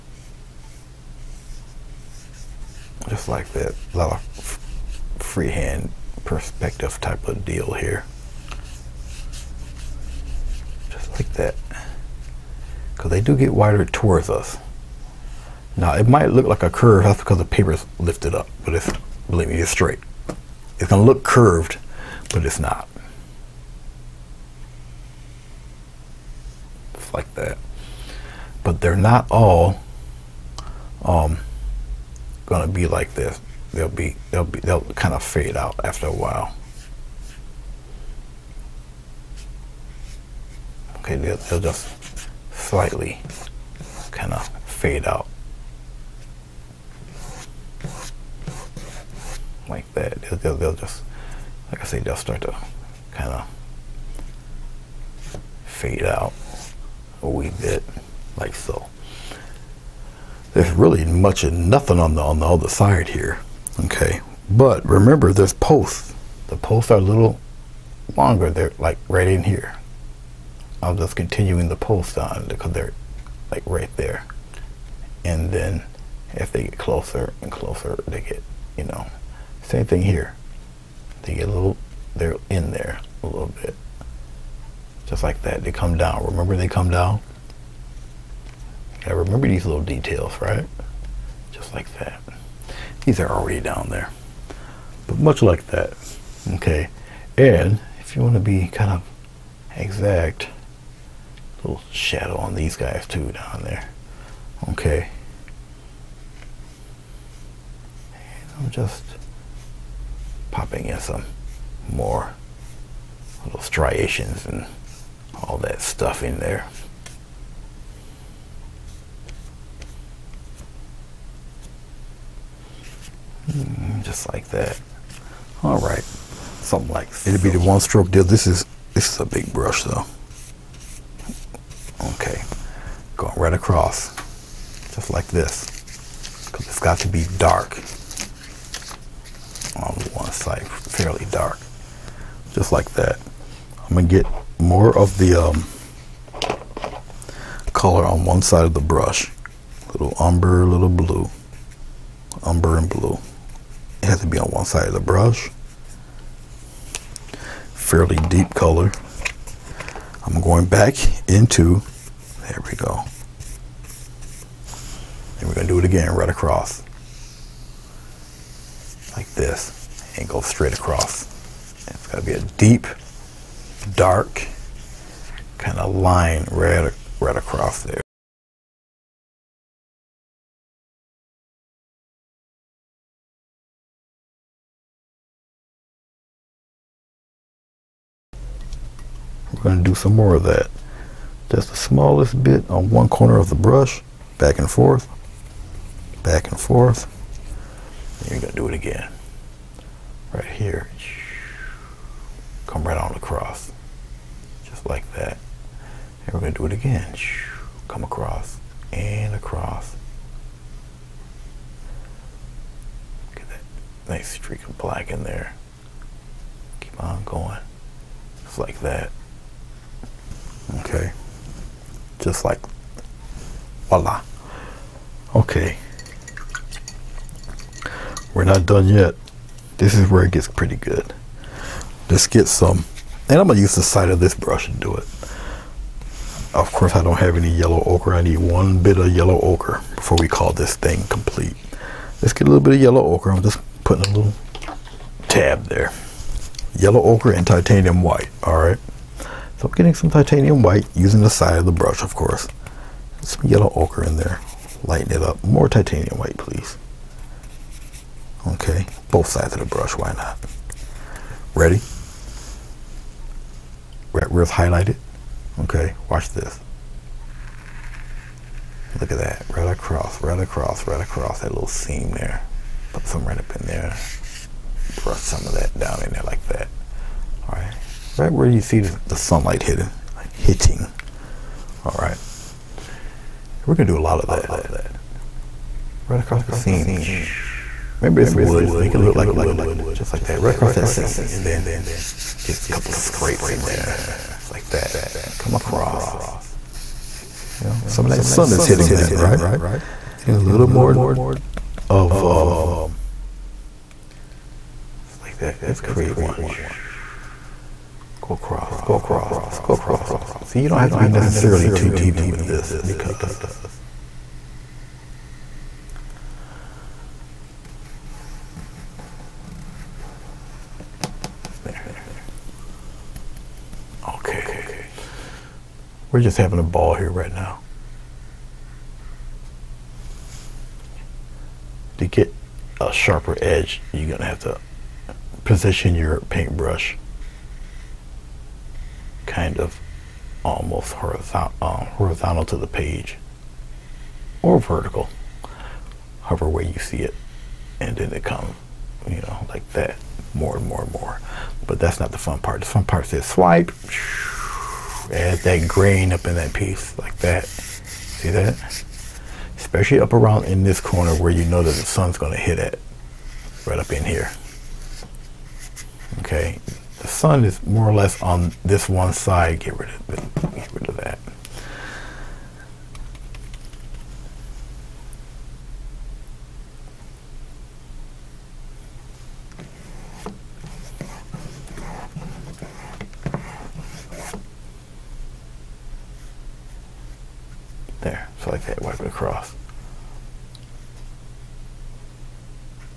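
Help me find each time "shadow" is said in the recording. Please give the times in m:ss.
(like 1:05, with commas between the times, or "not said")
1:41.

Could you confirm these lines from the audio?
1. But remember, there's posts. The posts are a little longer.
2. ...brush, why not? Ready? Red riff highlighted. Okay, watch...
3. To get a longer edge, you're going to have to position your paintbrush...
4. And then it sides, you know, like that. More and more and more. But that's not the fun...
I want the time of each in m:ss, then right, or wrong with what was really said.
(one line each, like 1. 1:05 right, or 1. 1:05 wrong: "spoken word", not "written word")
1. 1:04 right
2. 4:19 right
3. 5:31 wrong: "sharper", not "longer"
4. 5:47 wrong: "comes", not "sides".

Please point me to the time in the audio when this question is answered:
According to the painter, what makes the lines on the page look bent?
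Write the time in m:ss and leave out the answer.
0:17.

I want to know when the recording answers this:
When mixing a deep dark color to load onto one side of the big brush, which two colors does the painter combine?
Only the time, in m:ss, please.
2:32.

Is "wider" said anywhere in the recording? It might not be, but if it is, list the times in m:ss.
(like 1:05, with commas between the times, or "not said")
0:13.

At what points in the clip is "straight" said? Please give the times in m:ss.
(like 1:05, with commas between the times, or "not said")
0:19, 2:50.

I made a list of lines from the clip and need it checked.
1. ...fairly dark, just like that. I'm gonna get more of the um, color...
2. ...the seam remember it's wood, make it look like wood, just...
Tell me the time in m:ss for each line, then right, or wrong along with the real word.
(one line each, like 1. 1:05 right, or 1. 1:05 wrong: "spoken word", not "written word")
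1. 2:20 right
2. 4:46 right.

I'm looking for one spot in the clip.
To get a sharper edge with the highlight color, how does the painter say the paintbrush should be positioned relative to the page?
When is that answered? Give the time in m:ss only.
5:40.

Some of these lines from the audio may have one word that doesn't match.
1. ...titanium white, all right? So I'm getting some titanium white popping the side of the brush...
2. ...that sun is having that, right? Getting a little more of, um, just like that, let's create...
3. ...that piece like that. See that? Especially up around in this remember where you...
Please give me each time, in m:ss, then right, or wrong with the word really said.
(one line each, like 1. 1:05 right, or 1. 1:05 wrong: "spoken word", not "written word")
1. 4:07 wrong: "using", not "popping"
2. 4:58 wrong: "hitting", not "having"
3. 5:56 wrong: "corner", not "remember".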